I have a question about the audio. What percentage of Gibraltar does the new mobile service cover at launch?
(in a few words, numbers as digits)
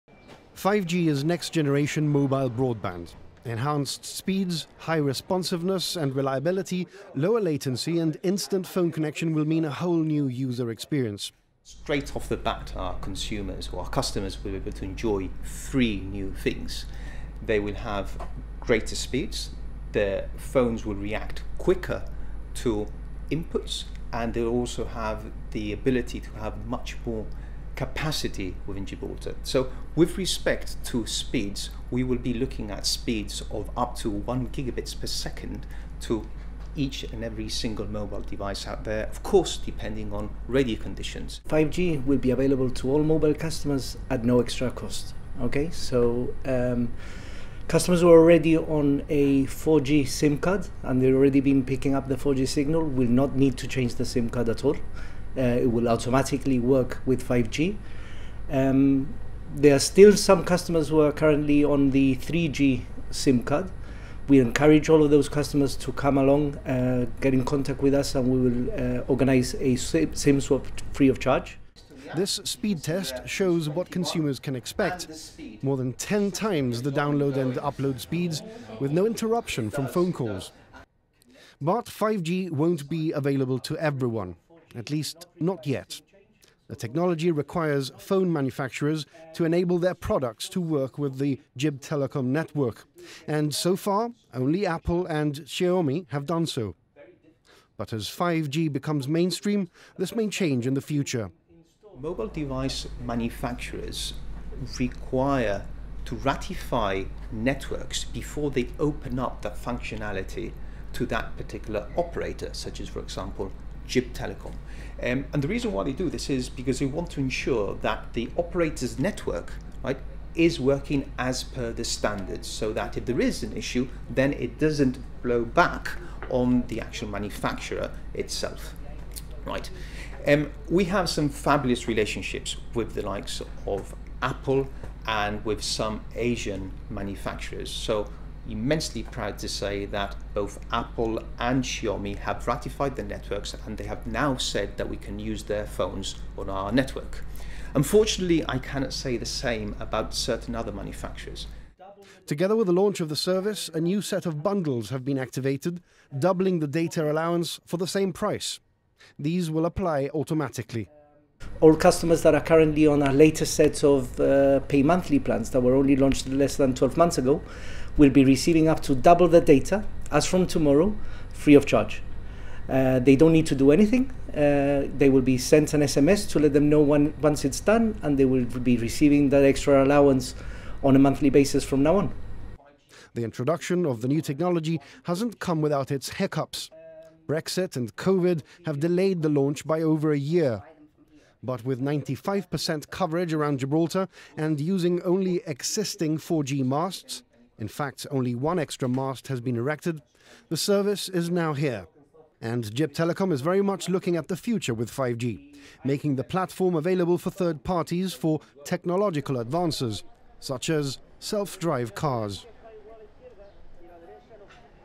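95%.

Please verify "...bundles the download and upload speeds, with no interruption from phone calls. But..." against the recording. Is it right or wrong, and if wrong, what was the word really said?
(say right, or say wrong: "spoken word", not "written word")
wrong: "times", not "bundles".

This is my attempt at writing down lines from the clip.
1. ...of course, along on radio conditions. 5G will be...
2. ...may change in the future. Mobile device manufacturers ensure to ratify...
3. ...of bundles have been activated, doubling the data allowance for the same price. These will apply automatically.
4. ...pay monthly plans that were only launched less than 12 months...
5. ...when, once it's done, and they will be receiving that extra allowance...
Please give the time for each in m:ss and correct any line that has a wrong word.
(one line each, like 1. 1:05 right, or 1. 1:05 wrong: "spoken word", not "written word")
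1. 0:39 wrong: "depending", not "along"
2. 1:40 wrong: "require", not "ensure"
3. 2:34 right
4. 2:44 right
5. 2:56 right.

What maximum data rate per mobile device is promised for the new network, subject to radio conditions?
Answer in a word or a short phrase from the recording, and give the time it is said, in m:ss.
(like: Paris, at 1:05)
1 gigabit per second, at 0:34.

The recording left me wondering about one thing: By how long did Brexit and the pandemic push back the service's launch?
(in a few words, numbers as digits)
over a year.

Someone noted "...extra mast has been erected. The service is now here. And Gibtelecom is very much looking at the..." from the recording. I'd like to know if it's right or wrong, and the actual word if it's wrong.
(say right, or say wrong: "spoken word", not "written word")
right.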